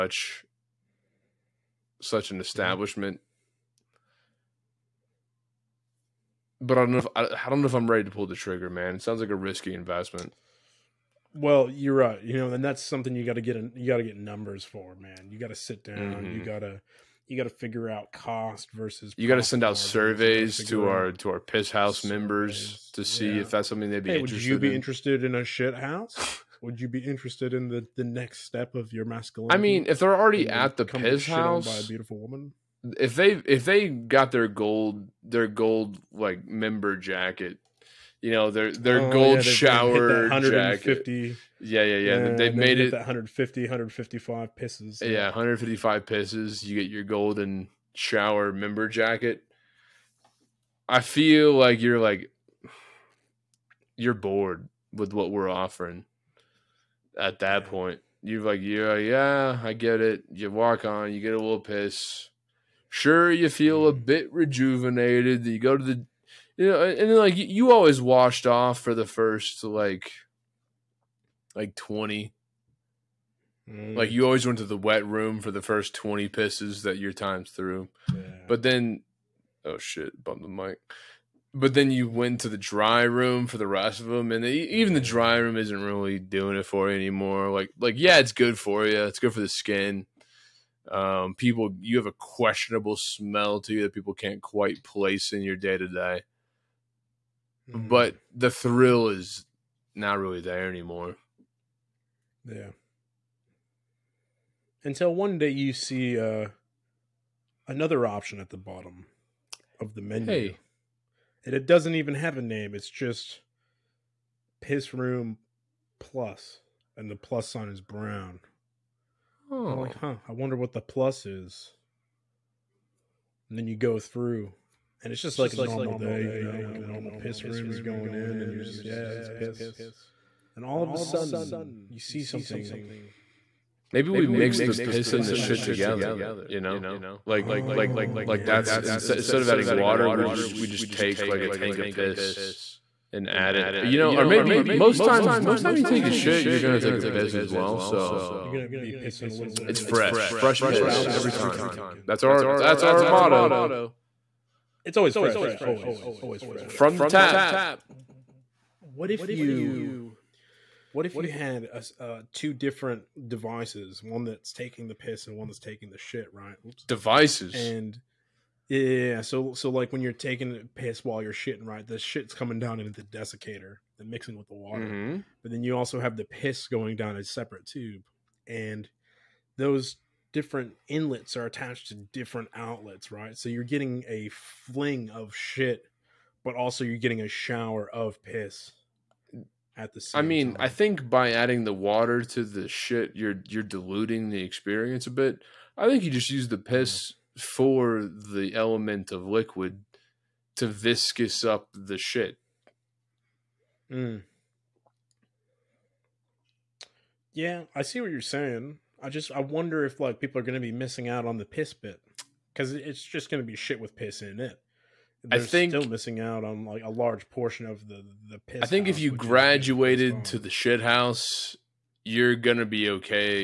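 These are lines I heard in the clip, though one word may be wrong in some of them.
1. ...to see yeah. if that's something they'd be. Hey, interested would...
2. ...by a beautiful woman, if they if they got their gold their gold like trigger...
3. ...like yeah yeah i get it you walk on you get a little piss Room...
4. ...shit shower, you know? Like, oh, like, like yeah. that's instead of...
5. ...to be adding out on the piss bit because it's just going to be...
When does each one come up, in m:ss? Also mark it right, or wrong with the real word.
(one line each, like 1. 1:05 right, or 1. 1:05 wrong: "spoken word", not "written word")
1. 0:22 right
2. 0:31 wrong: "member", not "trigger"
3. 0:58 wrong: "Sure", not "Room"
4. 2:15 wrong: "together", not "shower"
5. 3:30 wrong: "missing", not "adding".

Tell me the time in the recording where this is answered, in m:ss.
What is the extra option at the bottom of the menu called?
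1:54.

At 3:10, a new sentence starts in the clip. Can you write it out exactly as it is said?
I think by adding the water to the shit, you're you're diluting the experience a bit.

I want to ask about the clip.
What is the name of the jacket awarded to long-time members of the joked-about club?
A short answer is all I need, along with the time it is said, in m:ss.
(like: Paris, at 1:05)
golden shower member jacket, at 0:47.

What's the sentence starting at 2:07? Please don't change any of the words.
You're going in, and you're just, yeah, this piss.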